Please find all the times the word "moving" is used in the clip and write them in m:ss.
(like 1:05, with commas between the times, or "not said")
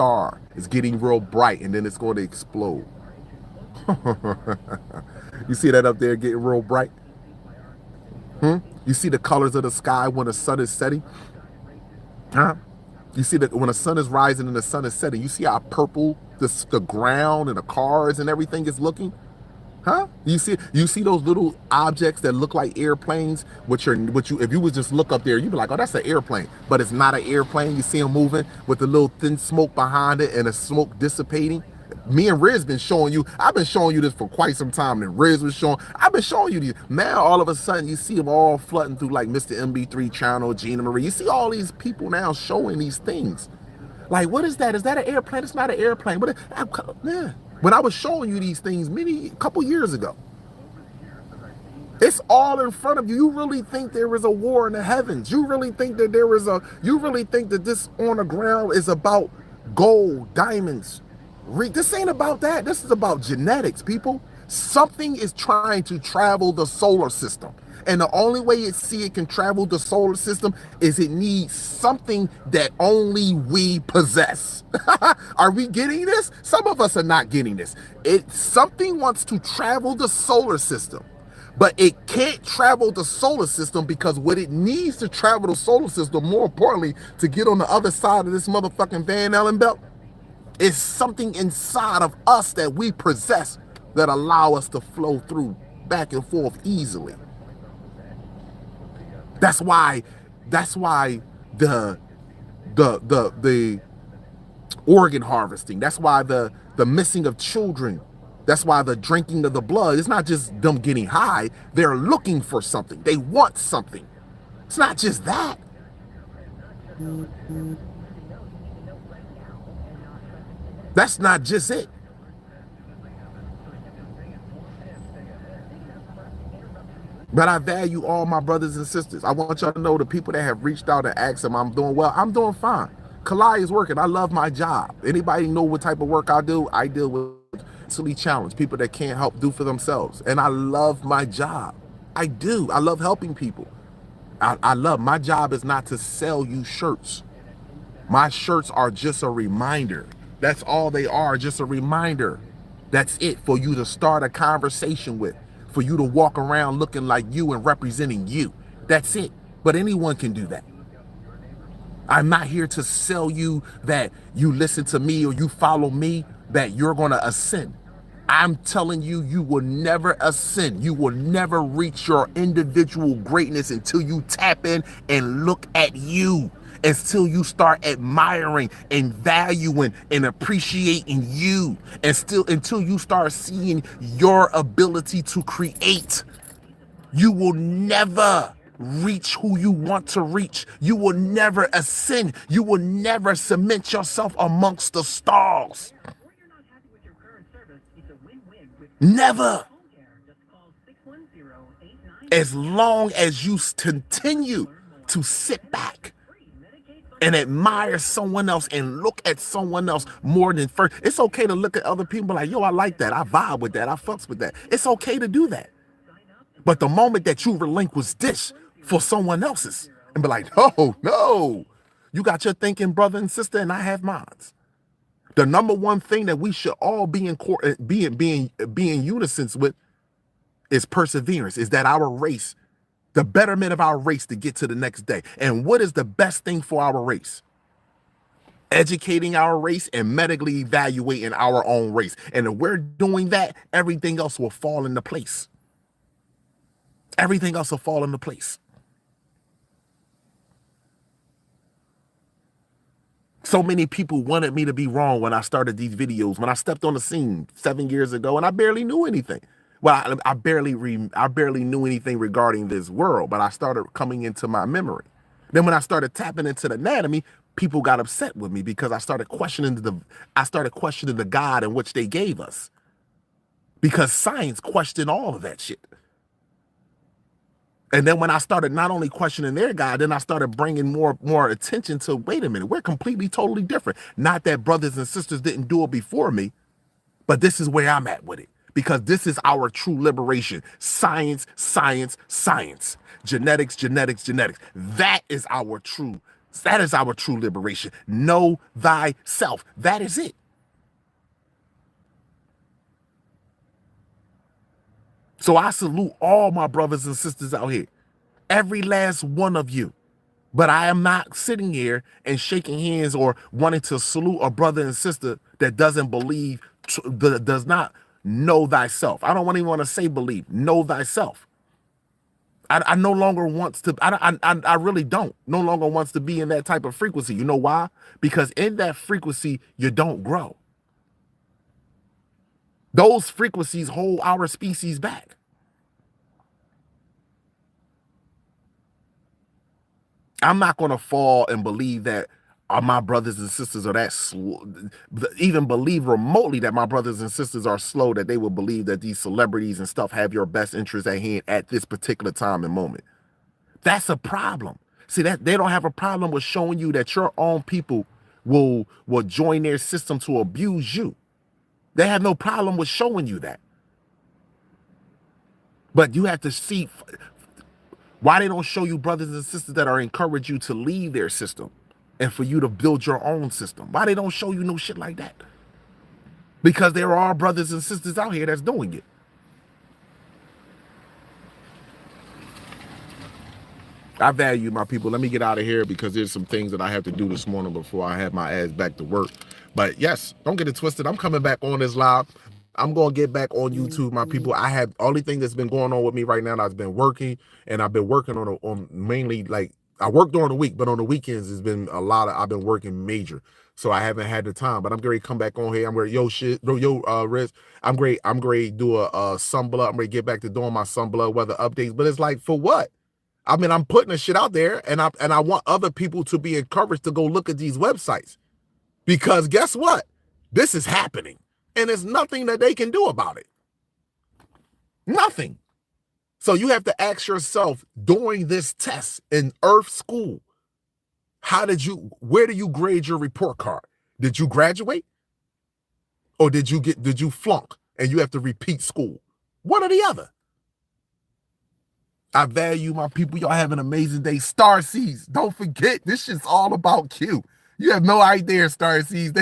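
0:28.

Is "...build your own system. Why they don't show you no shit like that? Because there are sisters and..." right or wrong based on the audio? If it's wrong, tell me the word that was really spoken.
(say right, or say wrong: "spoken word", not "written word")
wrong: "brothers", not "sisters".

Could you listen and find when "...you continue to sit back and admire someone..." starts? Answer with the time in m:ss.
3:23.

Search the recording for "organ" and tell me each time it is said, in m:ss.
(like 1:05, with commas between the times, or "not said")
1:44.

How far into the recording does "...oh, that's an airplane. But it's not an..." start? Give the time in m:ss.
0:25.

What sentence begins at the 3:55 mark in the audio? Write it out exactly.
And what is the best thing for our race?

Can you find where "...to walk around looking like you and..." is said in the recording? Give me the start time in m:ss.
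2:35.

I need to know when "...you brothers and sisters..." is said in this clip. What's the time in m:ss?
6:08.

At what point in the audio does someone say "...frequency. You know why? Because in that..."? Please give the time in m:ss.
5:26.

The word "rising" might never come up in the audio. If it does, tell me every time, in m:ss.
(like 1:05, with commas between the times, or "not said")
0:14.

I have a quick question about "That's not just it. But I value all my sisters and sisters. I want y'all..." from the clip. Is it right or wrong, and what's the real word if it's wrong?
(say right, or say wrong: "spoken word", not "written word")
wrong: "brothers", not "sisters".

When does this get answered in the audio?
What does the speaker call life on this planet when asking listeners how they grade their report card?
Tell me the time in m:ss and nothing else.
7:09.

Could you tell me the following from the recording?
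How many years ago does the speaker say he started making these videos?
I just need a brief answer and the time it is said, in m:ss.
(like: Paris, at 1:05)
7, at 4:17.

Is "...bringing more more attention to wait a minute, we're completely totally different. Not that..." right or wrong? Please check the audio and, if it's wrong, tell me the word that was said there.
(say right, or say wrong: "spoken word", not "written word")
right.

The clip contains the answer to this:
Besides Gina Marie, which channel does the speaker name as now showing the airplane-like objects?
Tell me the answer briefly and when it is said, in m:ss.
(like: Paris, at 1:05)
Mr. MB3, at 0:39.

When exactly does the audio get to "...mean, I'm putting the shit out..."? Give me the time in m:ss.
6:53.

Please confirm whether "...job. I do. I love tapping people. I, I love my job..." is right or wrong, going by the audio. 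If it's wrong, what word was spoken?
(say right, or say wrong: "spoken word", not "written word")
wrong: "helping", not "tapping".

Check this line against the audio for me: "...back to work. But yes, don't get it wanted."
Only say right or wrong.
wrong.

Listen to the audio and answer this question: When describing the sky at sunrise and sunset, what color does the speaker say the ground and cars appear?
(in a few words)
Purple.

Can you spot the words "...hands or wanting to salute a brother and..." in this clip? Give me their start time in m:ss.
5:12.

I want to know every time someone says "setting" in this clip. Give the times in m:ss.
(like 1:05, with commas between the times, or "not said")
0:10, 0:14.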